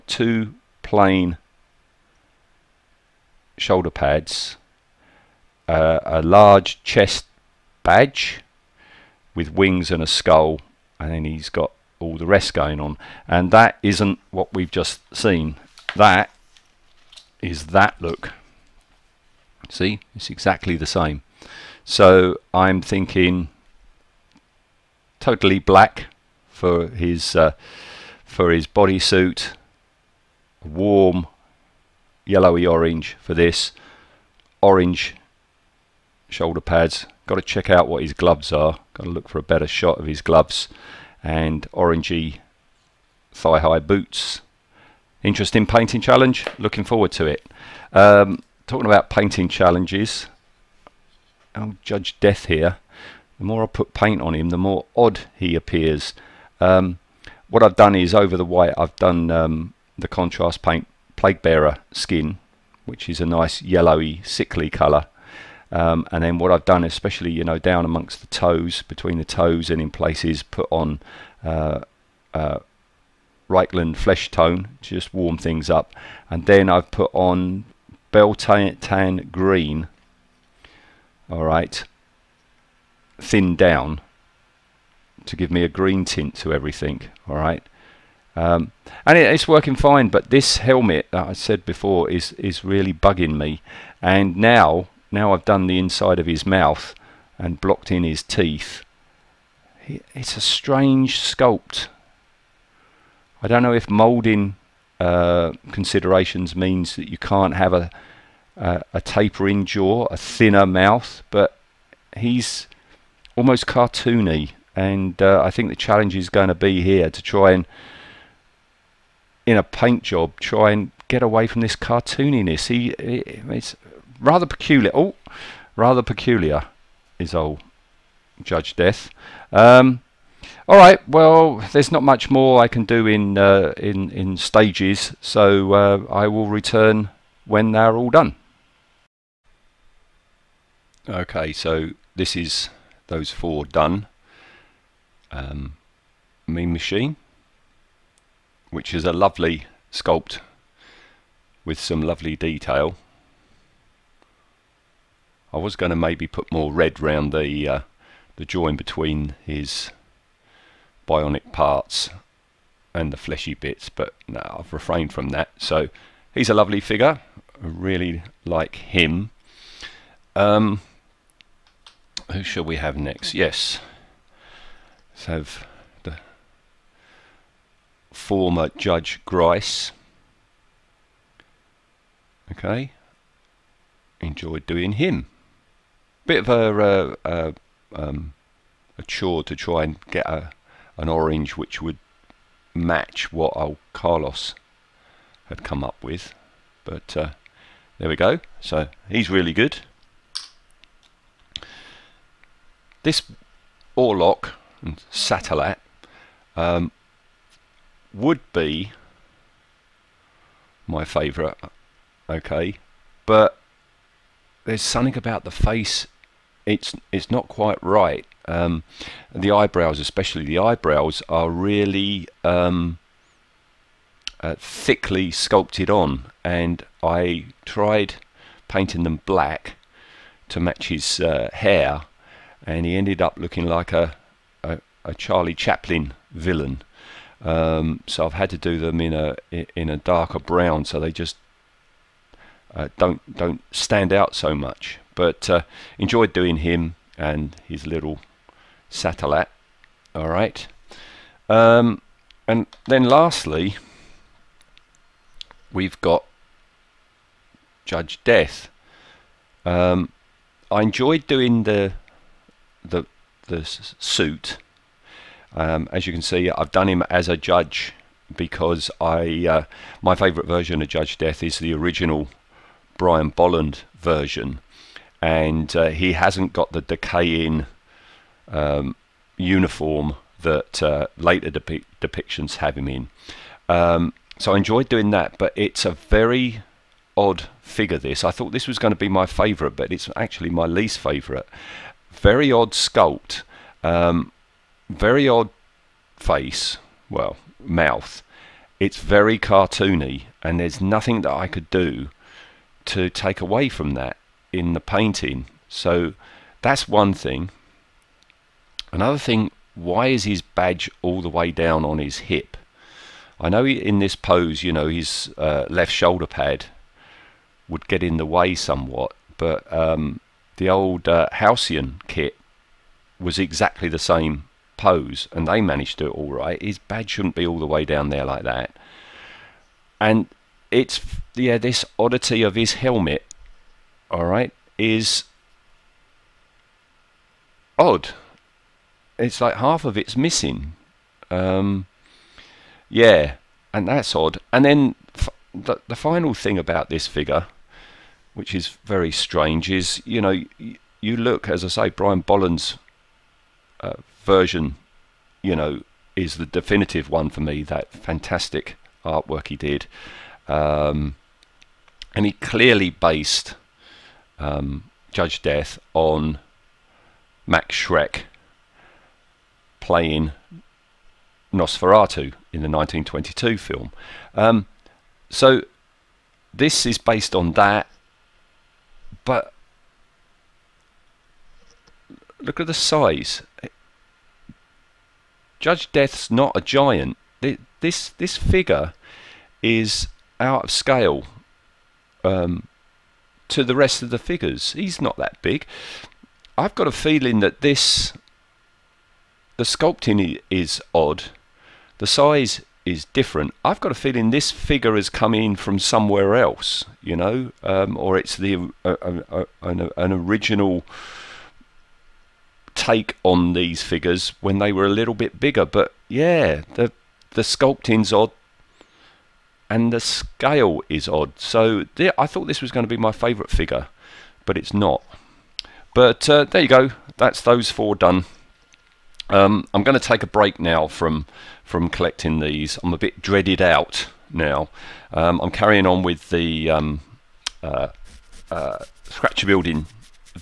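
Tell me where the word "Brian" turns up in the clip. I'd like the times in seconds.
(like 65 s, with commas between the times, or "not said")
272 s, 351 s.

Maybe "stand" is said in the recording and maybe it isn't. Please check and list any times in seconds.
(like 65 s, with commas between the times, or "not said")
243 s.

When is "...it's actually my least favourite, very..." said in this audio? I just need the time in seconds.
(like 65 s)
289 s.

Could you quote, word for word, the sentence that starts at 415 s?
But yeah, the the sculpting's odd and the scale is odd.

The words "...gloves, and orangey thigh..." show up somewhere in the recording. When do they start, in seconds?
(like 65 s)
40 s.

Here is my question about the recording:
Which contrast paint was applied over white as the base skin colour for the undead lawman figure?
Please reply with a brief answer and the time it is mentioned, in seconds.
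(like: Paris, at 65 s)
Plague Bearer skin, at 61 s.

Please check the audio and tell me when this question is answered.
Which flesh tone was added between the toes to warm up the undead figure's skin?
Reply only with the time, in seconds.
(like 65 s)
73 s.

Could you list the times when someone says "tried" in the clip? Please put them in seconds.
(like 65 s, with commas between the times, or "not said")
227 s.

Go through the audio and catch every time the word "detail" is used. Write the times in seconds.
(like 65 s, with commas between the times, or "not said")
152 s.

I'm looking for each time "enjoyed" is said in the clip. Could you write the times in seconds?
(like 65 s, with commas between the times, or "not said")
184 s, 245 s, 260 s, 284 s.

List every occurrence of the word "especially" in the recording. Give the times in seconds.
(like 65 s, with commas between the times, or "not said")
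66 s, 219 s.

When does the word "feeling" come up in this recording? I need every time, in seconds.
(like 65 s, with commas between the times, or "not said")
397 s, 403 s.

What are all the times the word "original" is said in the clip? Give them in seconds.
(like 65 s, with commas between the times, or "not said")
271 s, 410 s.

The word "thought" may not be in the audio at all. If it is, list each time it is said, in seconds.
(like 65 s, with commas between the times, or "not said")
288 s, 422 s.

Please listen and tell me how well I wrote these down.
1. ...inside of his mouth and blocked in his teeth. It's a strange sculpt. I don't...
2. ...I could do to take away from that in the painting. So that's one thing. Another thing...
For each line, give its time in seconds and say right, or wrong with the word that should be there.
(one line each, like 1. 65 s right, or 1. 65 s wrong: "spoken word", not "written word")
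1. 95 s right
2. 301 s right.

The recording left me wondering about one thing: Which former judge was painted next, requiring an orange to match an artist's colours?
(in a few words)
Grice.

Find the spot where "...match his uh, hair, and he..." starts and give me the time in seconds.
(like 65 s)
230 s.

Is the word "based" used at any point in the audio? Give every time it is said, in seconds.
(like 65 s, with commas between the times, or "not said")
362 s, 376 s.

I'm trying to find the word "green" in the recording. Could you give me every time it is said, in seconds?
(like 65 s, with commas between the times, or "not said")
79 s, 85 s.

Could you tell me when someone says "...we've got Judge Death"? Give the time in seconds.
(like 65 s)
255 s.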